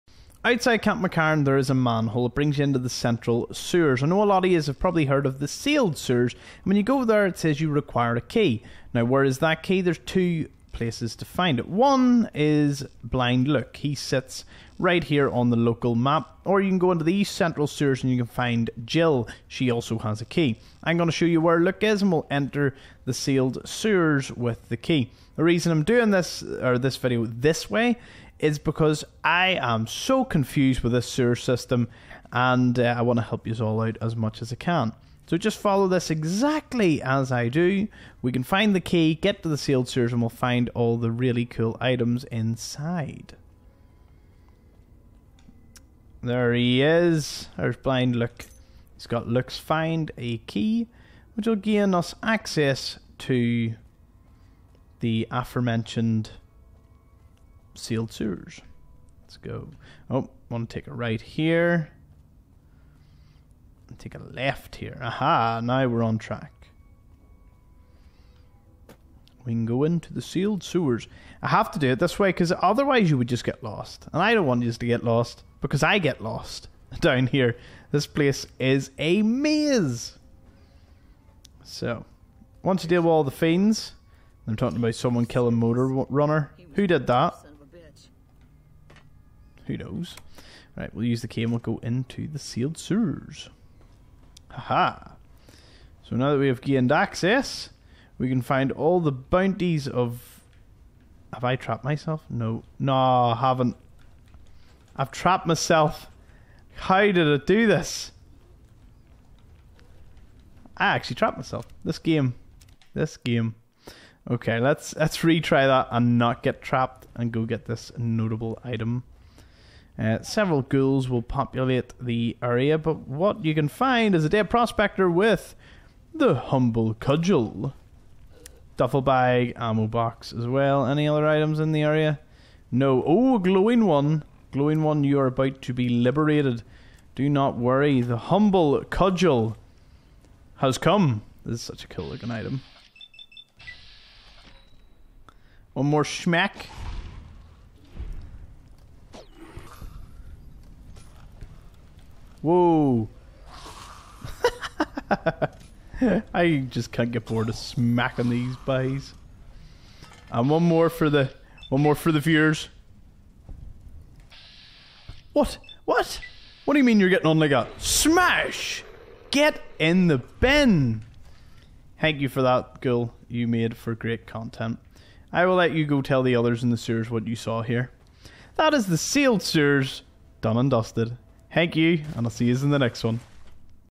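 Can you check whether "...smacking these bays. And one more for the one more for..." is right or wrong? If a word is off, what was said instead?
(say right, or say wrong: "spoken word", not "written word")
right.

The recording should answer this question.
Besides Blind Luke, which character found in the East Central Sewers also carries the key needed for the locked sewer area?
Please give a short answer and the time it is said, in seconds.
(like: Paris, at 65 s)
Jill, at 18 s.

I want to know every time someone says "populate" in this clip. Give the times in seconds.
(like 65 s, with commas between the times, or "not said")
121 s.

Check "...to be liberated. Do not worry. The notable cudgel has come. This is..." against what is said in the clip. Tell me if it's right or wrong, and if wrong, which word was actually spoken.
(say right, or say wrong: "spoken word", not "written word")
wrong: "humble", not "notable".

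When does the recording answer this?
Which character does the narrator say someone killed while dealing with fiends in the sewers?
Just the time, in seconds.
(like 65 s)
85 s.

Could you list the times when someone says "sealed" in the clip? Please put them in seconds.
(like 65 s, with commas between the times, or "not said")
5 s, 23 s, 39 s, 57 s, 70 s, 92 s, 178 s.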